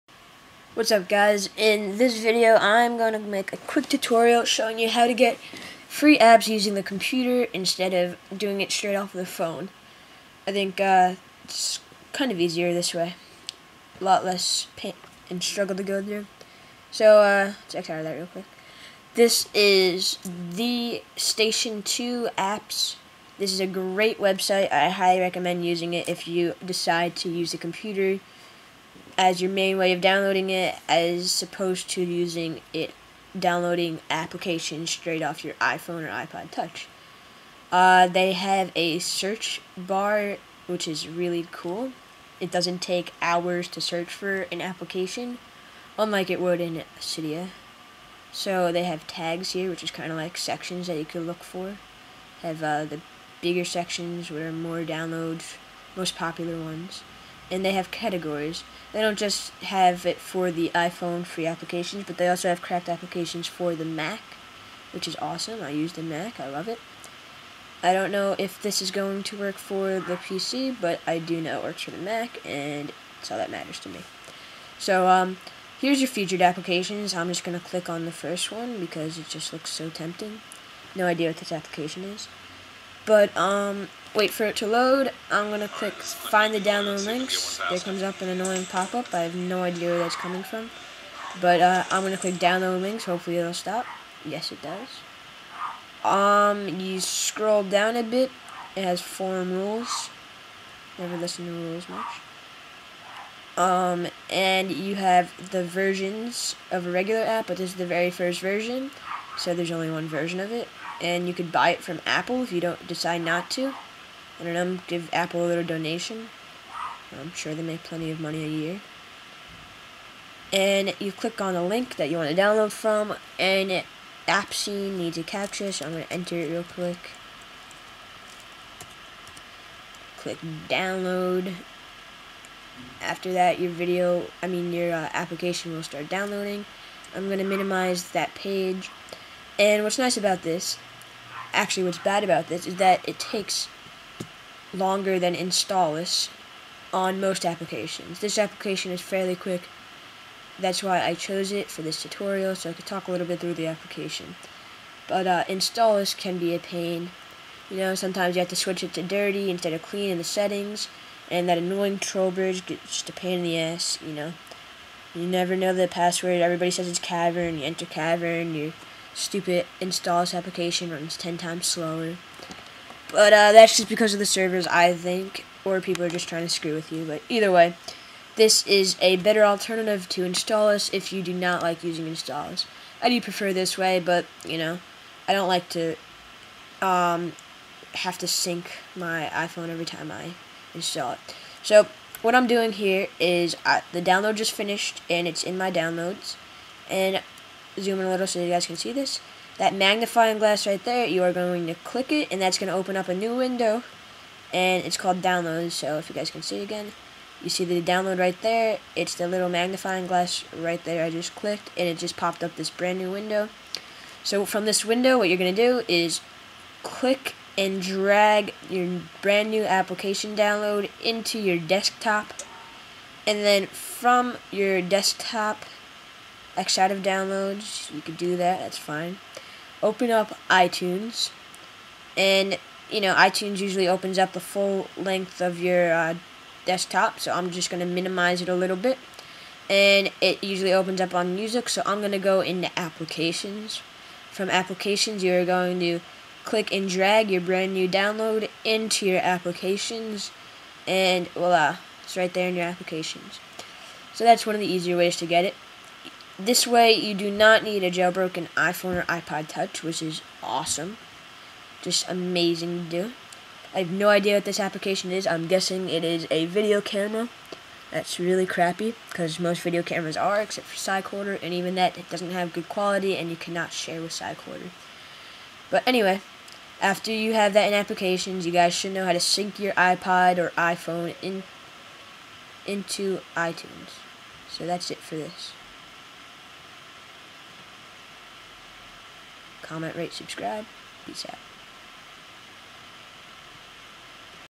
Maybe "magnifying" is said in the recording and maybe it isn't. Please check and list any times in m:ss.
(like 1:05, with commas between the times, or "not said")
3:19, 3:29.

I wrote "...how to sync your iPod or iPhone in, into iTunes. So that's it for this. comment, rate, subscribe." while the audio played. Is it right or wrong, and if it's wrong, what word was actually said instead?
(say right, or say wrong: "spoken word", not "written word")
right.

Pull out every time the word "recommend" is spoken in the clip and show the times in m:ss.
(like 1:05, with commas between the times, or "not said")
0:25.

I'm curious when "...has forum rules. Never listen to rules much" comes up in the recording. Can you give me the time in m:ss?
1:38.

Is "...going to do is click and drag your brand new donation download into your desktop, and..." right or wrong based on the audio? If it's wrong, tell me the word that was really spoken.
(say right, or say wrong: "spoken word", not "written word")
wrong: "application", not "donation".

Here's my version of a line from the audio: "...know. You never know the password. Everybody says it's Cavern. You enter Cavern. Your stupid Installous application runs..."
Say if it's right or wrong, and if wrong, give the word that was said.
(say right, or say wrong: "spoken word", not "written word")
right.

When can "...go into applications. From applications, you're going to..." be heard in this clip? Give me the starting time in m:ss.
4:02.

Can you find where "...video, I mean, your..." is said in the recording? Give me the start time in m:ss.
2:13.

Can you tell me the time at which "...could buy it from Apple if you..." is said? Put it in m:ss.
1:51.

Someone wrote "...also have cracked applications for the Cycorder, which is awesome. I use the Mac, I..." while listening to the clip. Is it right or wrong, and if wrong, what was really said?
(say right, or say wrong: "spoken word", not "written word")
wrong: "Mac", not "Cycorder".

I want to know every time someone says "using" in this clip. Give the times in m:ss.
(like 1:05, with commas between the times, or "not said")
0:06, 0:25, 0:32, 3:01.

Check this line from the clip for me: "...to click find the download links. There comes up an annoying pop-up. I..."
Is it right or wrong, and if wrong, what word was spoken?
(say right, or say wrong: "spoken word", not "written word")
right.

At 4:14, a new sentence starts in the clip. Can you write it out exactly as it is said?
So that's one of the easier ways to get it.